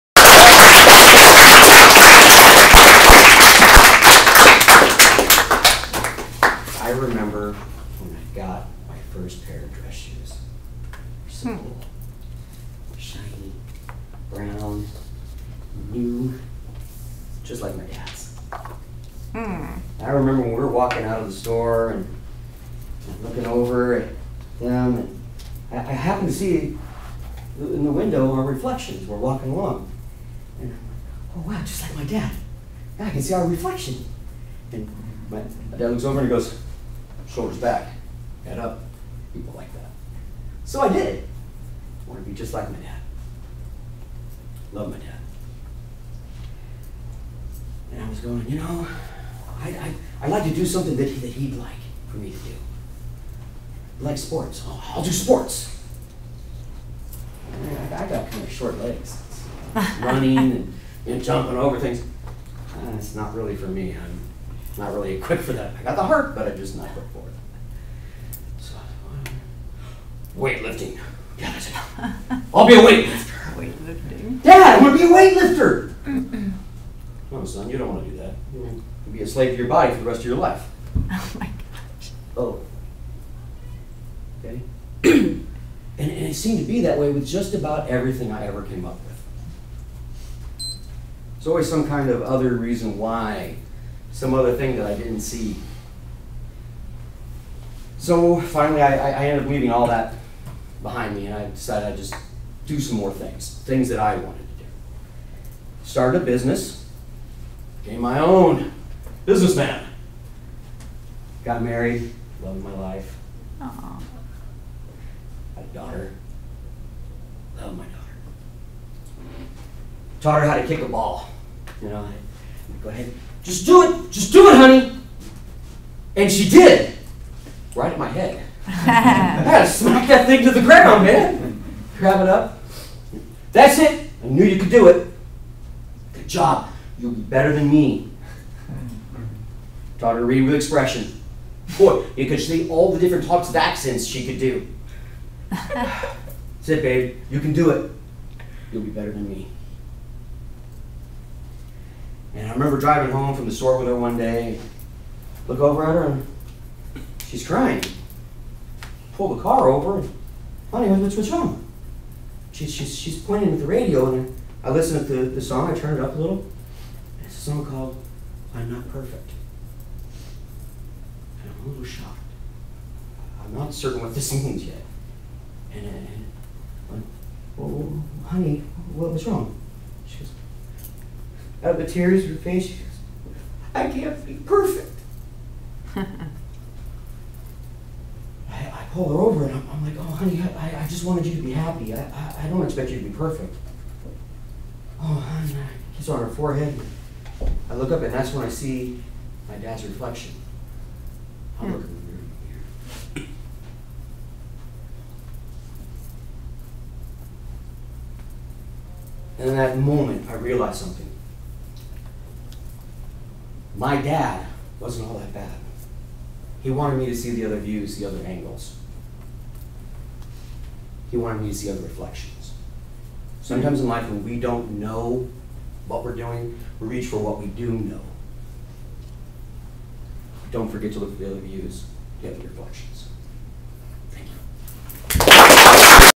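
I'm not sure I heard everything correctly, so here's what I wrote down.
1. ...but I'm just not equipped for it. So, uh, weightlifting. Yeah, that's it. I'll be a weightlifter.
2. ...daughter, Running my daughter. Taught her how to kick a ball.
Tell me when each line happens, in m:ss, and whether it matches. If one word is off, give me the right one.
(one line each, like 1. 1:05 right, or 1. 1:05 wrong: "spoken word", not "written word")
1. 1:06 right
2. 1:55 wrong: "Loved", not "Running".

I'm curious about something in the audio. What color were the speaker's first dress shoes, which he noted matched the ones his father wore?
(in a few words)
Brown.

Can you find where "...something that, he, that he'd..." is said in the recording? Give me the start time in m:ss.
0:50.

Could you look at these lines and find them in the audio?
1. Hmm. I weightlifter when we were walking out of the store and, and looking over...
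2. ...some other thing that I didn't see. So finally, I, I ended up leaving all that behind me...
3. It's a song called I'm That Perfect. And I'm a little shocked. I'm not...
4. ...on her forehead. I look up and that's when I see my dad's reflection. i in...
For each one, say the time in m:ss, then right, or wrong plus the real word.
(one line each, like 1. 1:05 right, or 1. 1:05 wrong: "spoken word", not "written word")
1. 0:19 wrong: "remember", not "weightlifter"
2. 1:34 right
3. 2:47 wrong: "Not", not "That"
4. 3:16 right.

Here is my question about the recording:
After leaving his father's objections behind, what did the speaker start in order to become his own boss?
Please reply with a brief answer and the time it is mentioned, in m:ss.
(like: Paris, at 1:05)
A business, at 1:46.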